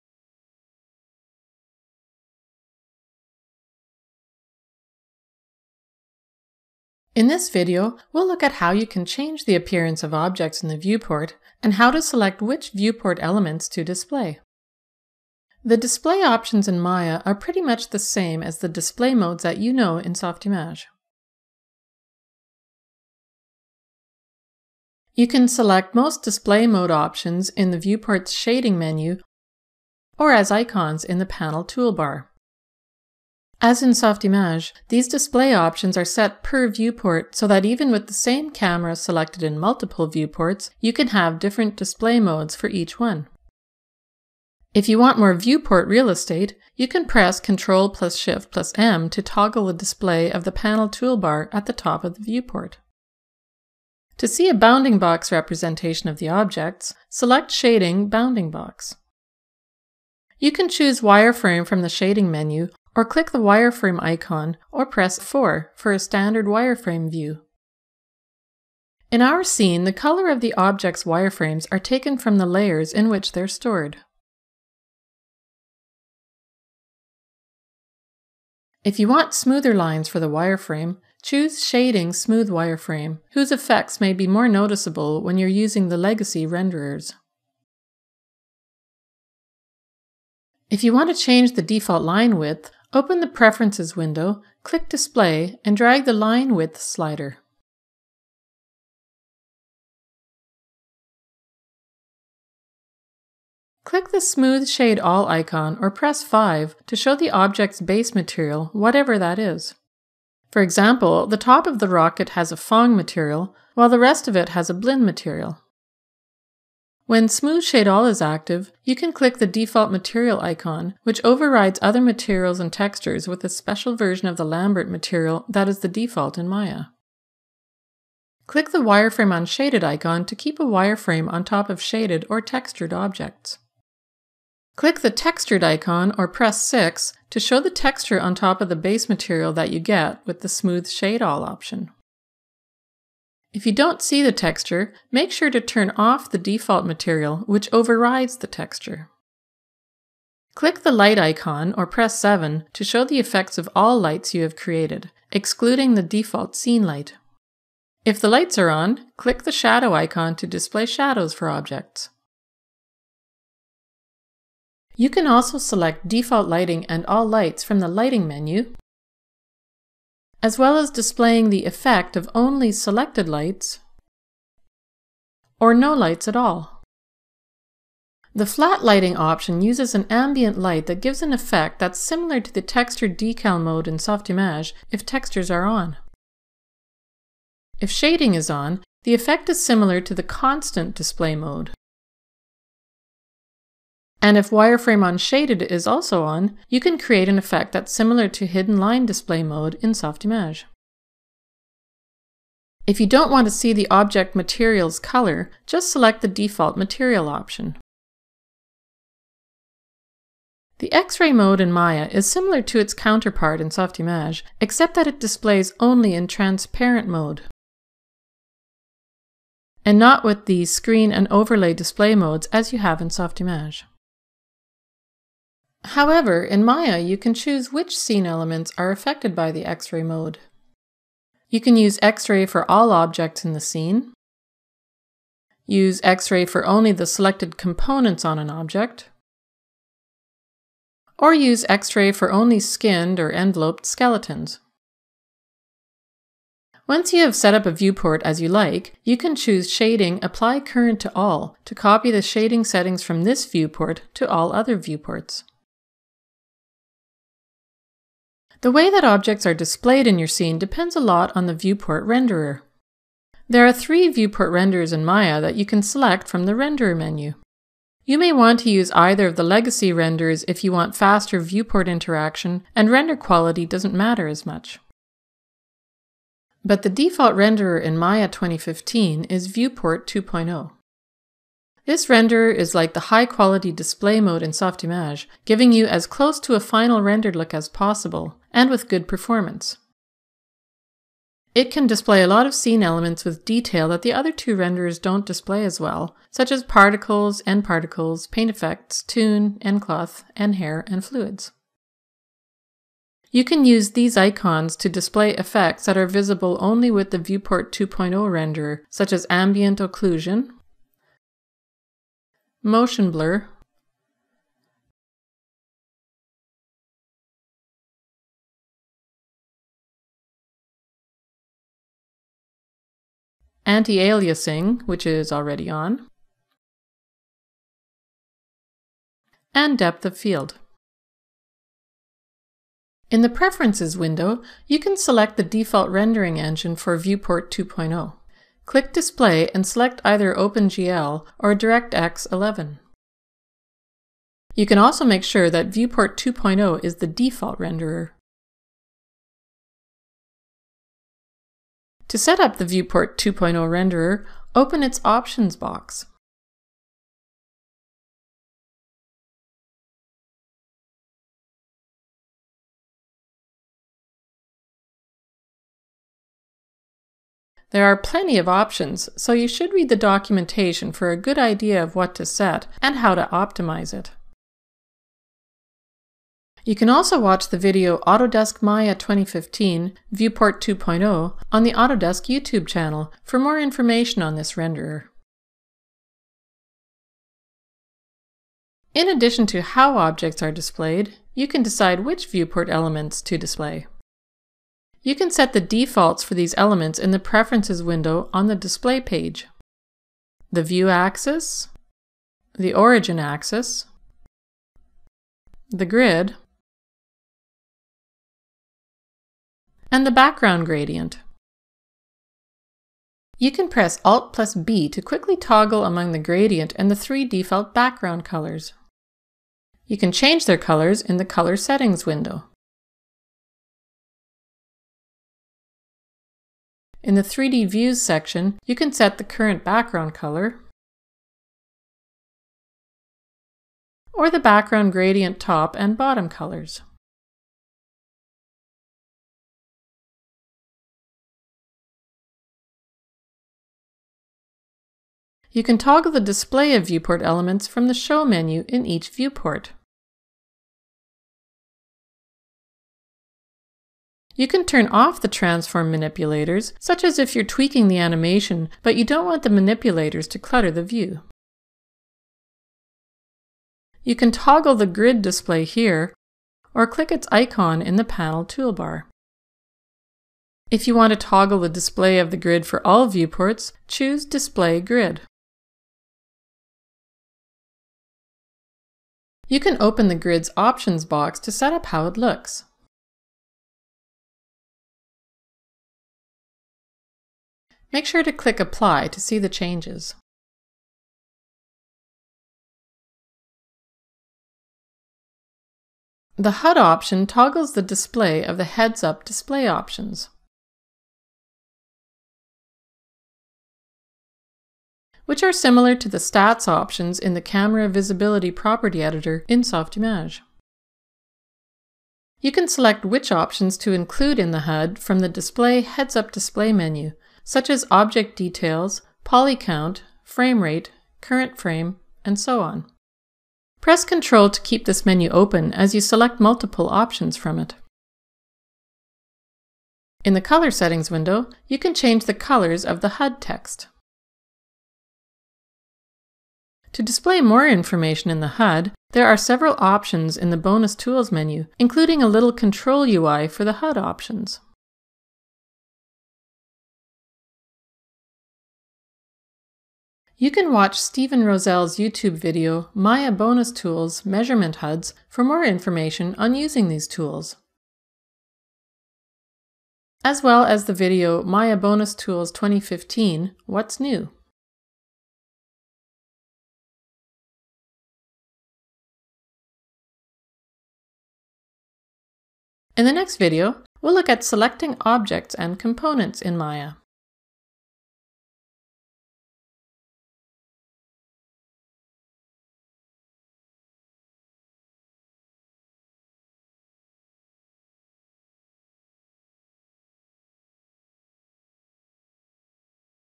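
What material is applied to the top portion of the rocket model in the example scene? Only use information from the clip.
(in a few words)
Phong.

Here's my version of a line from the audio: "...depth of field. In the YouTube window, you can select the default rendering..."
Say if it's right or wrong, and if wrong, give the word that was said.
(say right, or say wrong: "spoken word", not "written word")
wrong: "Preferences", not "YouTube".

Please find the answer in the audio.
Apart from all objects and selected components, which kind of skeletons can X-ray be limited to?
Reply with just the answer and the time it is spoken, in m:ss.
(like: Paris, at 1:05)
skinned or enveloped, at 4:02.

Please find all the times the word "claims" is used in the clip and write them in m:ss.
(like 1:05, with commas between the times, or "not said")
not said.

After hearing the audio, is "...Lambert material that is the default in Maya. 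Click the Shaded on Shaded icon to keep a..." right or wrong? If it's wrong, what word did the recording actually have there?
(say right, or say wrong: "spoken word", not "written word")
wrong: "Wireframe", not "Shaded".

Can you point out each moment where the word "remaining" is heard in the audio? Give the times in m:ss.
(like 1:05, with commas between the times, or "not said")
not said.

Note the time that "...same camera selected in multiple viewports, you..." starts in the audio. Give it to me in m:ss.
0:38.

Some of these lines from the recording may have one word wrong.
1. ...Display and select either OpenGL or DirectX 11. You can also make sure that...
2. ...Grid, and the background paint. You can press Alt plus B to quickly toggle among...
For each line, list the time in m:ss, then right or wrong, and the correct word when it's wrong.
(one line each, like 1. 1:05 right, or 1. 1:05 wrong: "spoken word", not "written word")
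1. 5:38 right
2. 6:45 wrong: "gradient", not "paint".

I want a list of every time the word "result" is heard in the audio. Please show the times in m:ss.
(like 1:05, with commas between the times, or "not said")
not said.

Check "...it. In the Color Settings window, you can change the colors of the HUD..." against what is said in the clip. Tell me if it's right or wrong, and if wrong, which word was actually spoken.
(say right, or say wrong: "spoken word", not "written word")
right.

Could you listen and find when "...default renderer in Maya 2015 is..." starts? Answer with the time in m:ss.
4:36.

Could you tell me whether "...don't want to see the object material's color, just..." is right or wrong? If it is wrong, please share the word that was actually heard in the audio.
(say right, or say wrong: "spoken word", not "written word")
right.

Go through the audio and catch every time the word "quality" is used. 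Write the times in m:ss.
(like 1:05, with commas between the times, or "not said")
4:33, 4:43.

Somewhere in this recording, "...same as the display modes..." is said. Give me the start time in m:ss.
0:17.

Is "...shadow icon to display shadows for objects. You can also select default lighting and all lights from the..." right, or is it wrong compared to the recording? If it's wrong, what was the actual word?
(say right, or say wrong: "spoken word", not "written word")
right.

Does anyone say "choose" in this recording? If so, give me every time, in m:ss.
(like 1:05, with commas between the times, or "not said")
1:00, 1:21, 3:47, 4:09, 7:53.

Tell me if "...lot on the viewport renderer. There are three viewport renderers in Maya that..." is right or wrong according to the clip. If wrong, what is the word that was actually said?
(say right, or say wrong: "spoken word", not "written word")
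right.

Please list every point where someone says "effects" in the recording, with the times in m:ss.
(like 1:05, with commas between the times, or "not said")
1:23, 2:33, 2:51, 3:01, 3:09, 3:17, 4:58, 5:05.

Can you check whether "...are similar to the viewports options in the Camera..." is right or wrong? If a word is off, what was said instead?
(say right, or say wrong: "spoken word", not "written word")
wrong: "stats", not "viewports".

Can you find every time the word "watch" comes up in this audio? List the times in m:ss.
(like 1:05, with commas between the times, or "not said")
6:17, 9:10.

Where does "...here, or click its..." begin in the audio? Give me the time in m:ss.
7:45.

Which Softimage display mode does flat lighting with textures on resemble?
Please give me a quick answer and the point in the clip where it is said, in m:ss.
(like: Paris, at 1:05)
texture decal, at 3:02.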